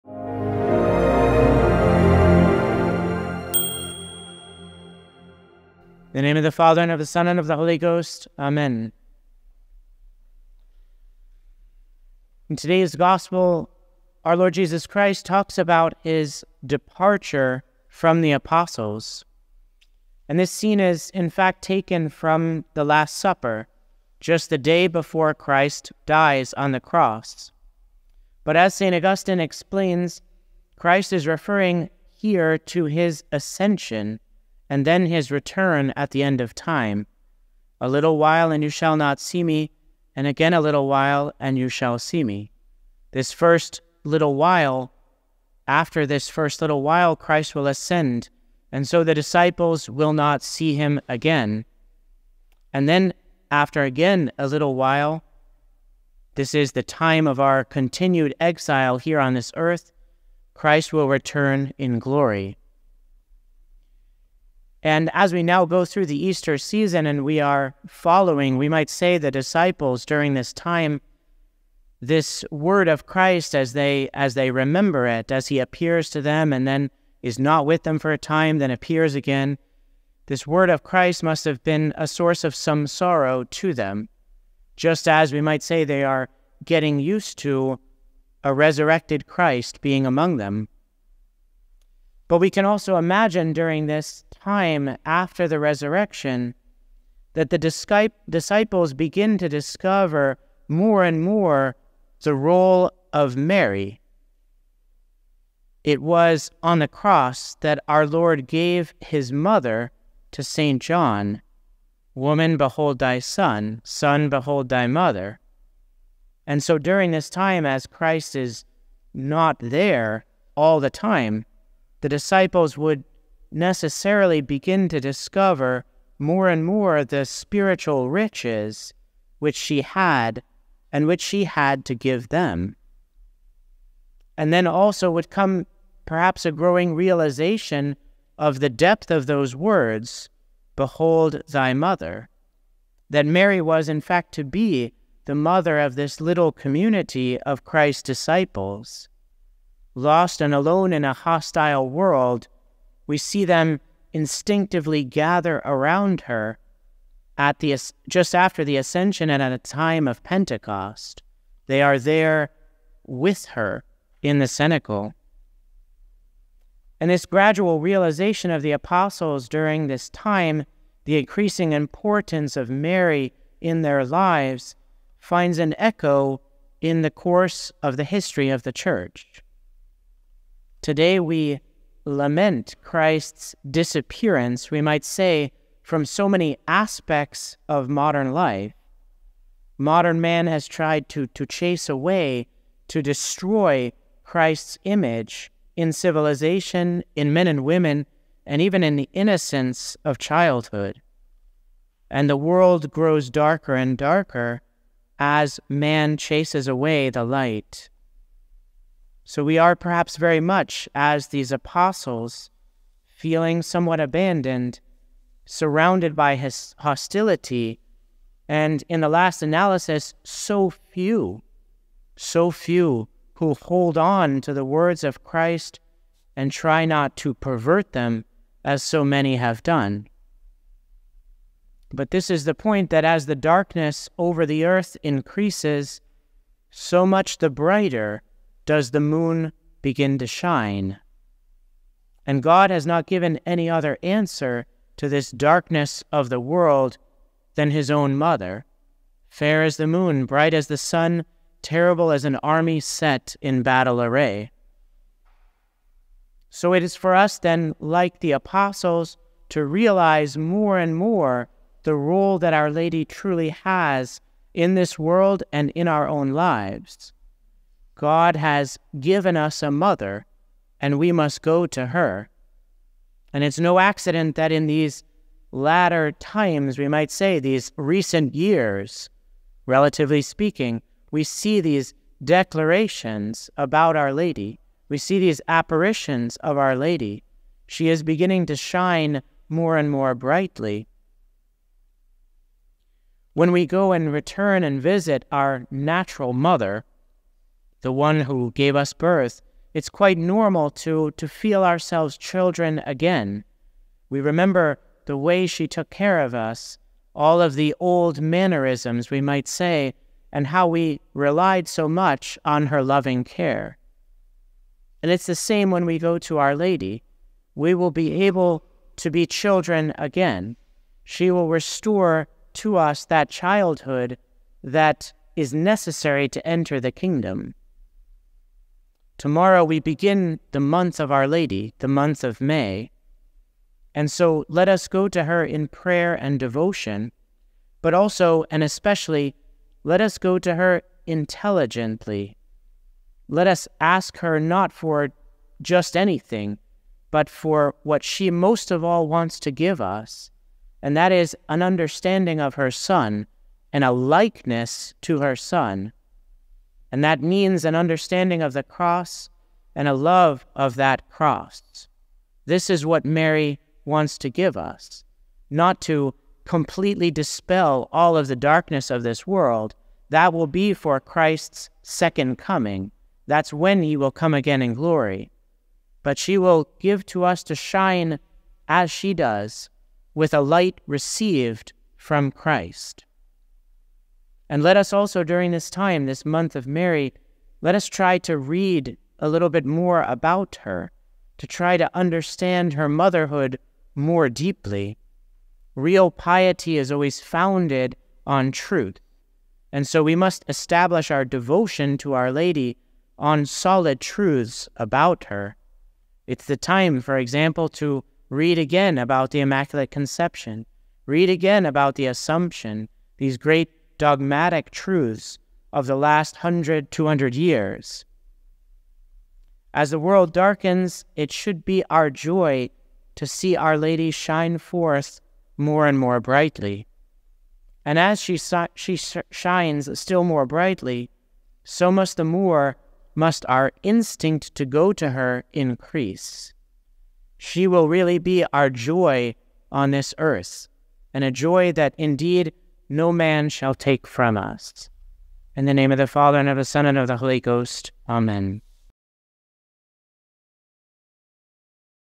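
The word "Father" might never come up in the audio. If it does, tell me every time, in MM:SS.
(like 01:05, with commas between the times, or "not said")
00:06, 07:26.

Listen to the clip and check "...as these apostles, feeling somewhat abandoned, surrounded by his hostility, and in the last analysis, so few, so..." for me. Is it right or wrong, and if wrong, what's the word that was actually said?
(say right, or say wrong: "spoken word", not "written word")
right.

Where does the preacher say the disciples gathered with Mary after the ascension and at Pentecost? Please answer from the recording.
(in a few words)
The cenacle.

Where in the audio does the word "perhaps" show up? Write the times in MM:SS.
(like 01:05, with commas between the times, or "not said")
02:16, 03:29.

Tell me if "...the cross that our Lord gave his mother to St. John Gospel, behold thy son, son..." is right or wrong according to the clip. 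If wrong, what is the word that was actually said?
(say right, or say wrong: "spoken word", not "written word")
wrong: "Woman", not "Gospel".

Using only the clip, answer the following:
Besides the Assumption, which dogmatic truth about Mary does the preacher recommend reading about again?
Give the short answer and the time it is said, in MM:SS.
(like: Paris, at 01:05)
The Immaculate Conception, at 06:49.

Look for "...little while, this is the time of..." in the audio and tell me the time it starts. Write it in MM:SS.
00:54.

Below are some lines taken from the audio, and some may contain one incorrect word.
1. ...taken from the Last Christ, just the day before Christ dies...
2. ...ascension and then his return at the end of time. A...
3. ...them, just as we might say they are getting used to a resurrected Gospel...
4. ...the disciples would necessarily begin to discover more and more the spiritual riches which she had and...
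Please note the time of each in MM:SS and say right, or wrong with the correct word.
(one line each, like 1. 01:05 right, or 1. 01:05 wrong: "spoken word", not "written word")
1. 00:21 wrong: "Supper", not "Christ"
2. 00:33 right
3. 01:23 wrong: "Christ", not "Gospel"
4. 02:02 right.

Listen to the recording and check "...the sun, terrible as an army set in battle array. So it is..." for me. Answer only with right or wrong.
right.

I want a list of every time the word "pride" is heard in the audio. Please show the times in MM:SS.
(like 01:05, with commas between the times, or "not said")
not said.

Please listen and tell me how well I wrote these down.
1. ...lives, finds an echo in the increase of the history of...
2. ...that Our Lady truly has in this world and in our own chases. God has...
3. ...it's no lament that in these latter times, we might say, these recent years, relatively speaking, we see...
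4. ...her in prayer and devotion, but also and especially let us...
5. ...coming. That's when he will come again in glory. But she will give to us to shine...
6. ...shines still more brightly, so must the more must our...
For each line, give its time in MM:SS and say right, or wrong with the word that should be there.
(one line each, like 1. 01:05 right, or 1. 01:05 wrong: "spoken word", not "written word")
1. 02:54 wrong: "course", not "increase"
2. 04:22 wrong: "lives", not "chases"
3. 04:33 wrong: "accident", not "lament"
4. 05:35 right
5. 06:12 right
6. 07:09 right.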